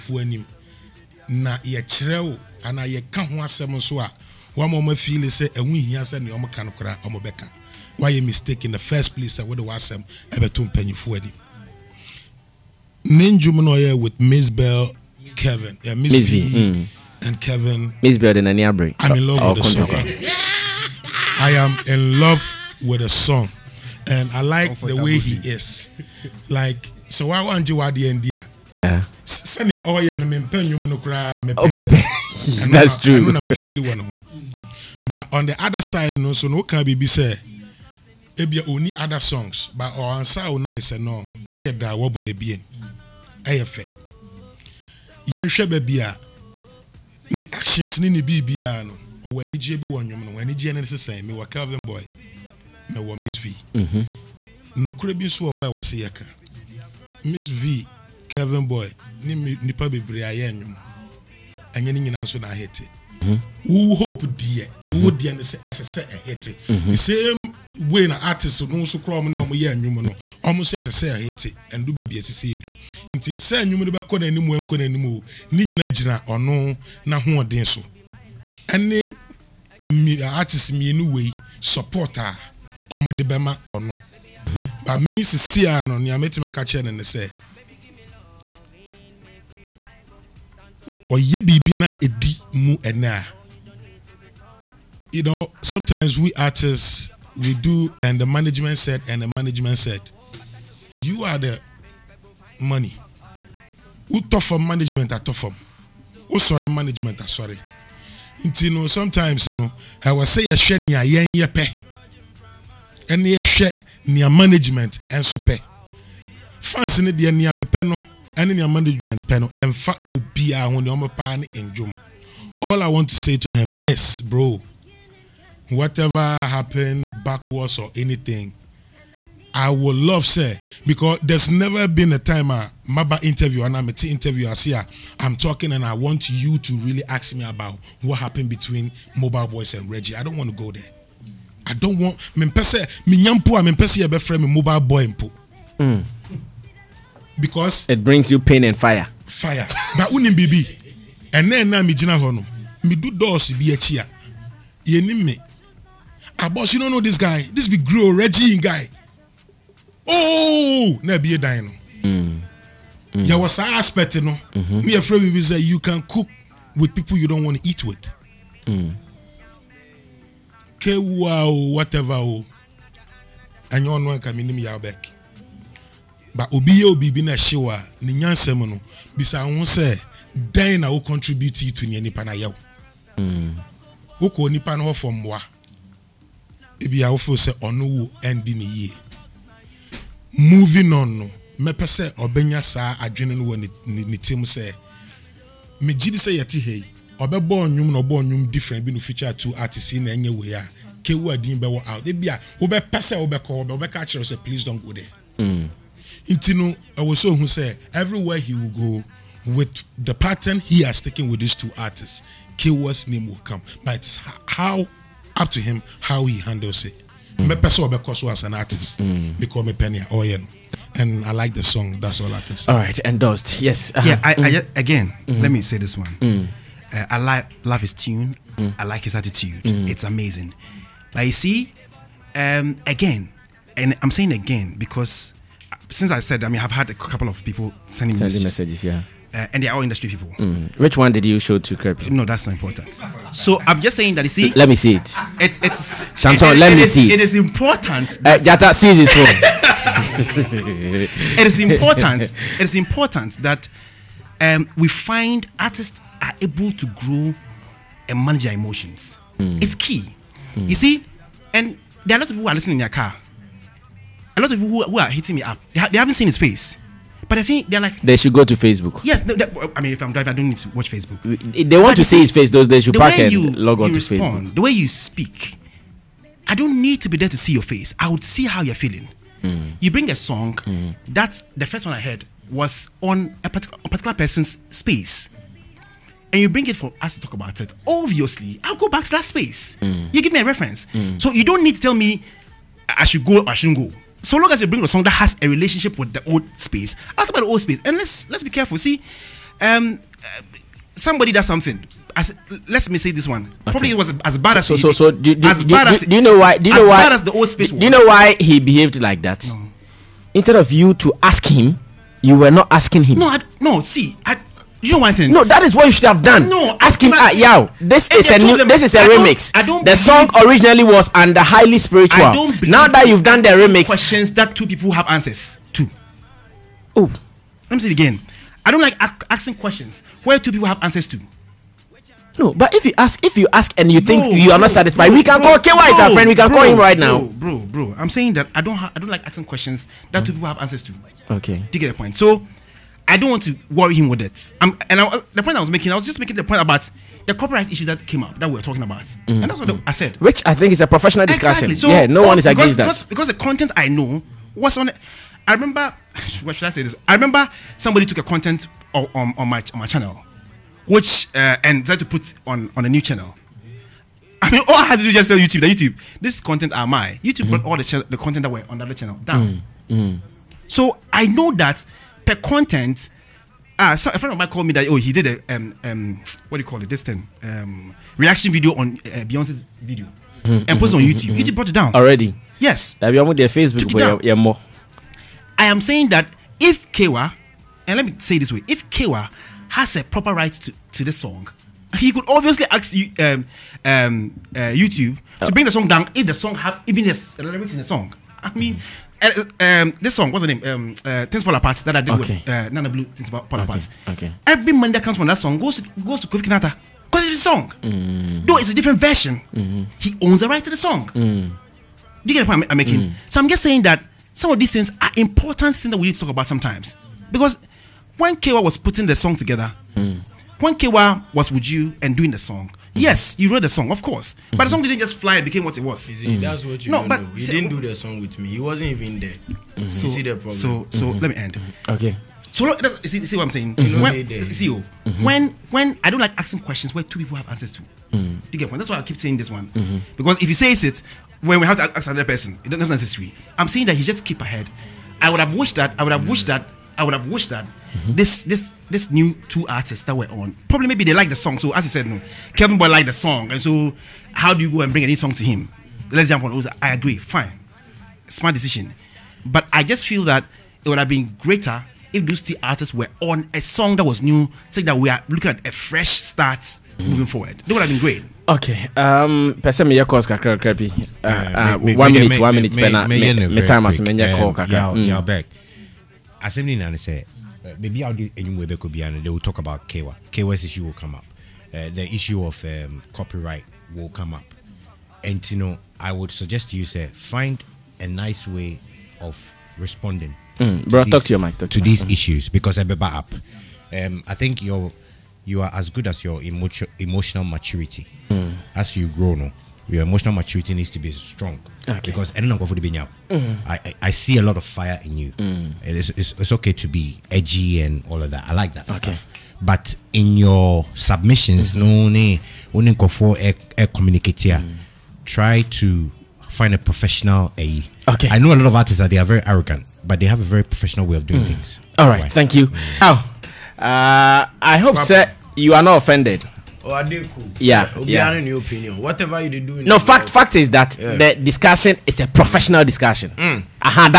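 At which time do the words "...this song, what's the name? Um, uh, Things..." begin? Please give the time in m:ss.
6:40.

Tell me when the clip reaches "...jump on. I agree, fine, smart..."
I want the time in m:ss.
7:36.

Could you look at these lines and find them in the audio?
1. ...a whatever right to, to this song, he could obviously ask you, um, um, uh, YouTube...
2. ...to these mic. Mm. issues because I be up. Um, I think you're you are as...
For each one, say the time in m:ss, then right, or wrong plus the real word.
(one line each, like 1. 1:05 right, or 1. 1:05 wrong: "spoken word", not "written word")
1. 6:29 wrong: "proper", not "whatever"
2. 8:11 right.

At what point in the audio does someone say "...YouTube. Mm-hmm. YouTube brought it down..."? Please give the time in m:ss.
6:21.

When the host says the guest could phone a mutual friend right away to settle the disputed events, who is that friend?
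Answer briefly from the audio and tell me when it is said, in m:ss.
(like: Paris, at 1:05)
KY, at 5:35.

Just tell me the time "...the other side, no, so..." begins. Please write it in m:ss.
0:35.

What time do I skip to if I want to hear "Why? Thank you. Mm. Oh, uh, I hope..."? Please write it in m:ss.
8:42.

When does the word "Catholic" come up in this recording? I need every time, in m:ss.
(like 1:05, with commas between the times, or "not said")
not said.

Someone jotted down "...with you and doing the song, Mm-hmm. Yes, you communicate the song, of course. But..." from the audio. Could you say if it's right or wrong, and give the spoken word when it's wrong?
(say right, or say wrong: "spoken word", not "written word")
wrong: "wrote", not "communicate".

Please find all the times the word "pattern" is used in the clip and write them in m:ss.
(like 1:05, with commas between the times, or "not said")
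3:30.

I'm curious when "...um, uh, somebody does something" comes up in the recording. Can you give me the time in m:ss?
4:59.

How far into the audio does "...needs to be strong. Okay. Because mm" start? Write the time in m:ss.
8:20.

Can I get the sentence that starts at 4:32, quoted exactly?
Those they should the park and you, log on to respond, Facebook.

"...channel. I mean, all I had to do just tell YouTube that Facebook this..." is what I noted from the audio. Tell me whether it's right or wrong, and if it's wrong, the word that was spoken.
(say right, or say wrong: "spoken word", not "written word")
wrong: "YouTube", not "Facebook".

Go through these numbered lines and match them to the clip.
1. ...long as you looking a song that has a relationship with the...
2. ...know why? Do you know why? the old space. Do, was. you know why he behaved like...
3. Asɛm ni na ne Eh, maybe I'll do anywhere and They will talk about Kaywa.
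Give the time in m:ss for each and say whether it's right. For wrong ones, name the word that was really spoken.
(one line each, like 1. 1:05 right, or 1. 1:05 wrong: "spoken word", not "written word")
1. 4:54 wrong: "bring", not "looking"
2. 5:06 right
3. 7:56 right.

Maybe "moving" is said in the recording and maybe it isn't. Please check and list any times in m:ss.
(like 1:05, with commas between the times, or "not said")
3:10, 7:47.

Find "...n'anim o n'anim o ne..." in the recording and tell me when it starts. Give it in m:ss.
1:14.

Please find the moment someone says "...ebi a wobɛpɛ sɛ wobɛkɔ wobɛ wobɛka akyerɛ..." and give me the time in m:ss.
3:22.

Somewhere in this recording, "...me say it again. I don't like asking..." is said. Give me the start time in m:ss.
5:27.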